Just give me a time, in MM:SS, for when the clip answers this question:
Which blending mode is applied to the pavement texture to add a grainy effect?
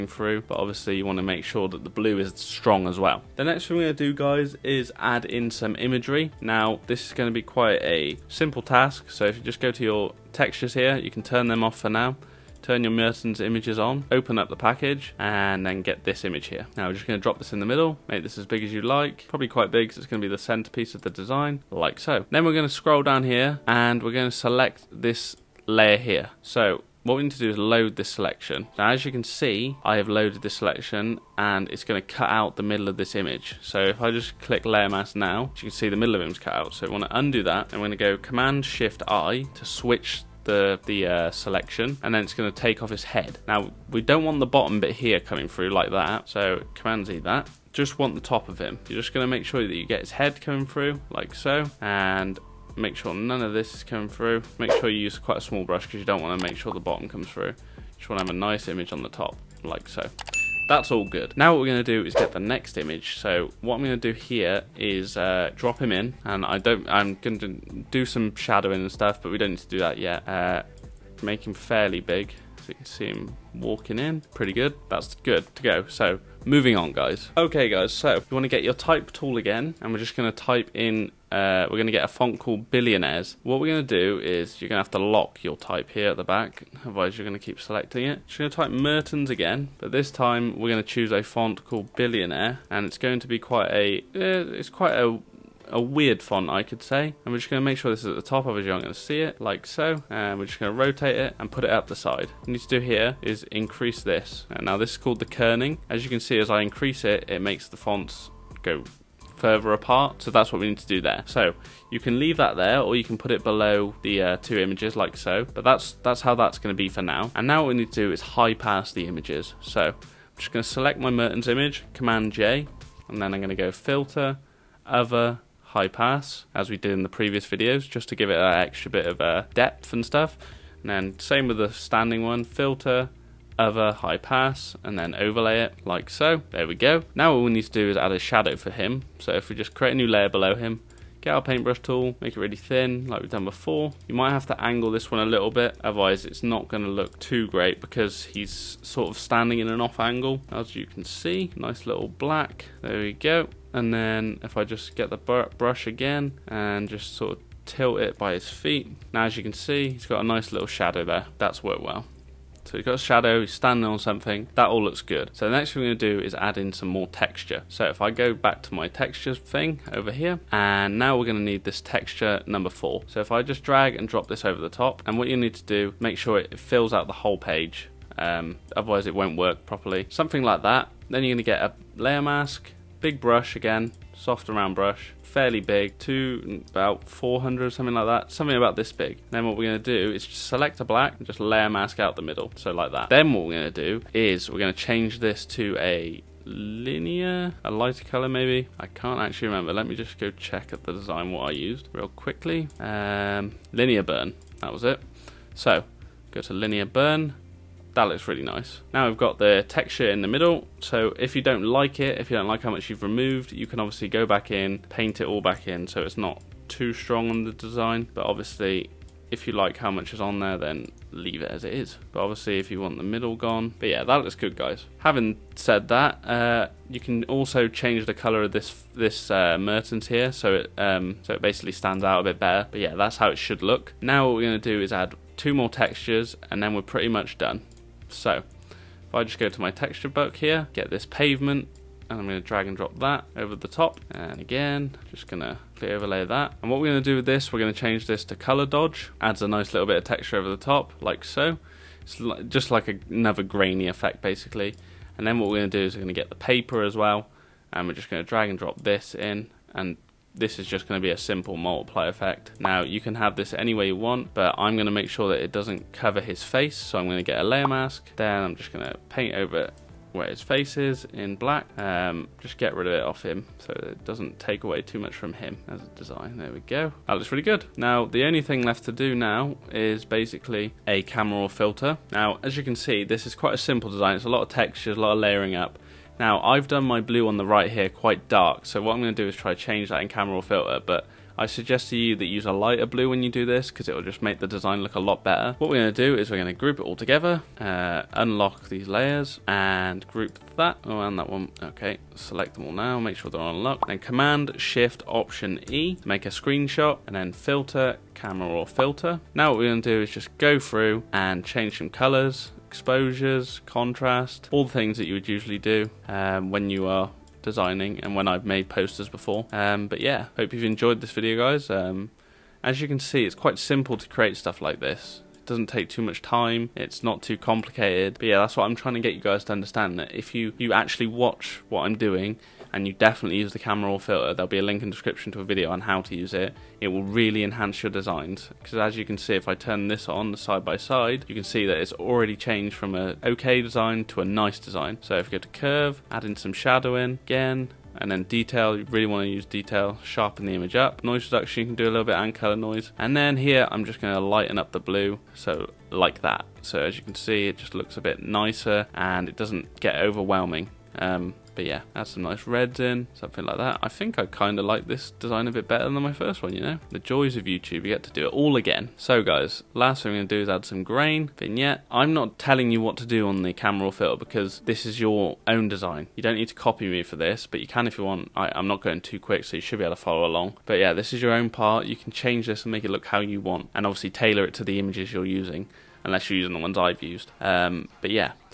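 04:08.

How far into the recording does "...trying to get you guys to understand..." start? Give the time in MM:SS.
05:28.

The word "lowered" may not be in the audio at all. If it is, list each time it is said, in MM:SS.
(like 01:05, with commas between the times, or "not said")
not said.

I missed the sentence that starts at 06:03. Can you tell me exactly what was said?
I think I kind of like this design a bit better than my first one, you know?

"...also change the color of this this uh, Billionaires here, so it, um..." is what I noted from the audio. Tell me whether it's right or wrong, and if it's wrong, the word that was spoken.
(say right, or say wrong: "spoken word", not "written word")
wrong: "Mertens", not "Billionaires".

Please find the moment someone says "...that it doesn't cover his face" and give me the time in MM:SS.
04:25.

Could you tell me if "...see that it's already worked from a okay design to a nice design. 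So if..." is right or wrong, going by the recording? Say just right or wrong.
wrong.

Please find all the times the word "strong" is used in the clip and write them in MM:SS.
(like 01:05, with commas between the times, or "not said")
00:02, 03:36.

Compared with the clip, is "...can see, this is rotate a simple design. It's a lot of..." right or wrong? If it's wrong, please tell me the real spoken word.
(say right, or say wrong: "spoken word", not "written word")
wrong: "quite", not "rotate".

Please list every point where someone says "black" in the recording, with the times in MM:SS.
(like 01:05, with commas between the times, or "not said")
02:32, 03:10, 04:31.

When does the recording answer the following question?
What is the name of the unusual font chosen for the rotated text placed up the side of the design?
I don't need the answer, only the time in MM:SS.
01:31.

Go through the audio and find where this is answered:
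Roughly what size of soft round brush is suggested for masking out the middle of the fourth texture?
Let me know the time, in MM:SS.
03:07.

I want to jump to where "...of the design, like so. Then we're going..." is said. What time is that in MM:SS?
00:20.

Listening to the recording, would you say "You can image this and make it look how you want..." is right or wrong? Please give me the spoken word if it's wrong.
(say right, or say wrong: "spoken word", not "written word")
wrong: "change", not "image".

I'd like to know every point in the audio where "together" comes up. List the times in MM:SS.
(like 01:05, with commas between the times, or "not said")
04:56.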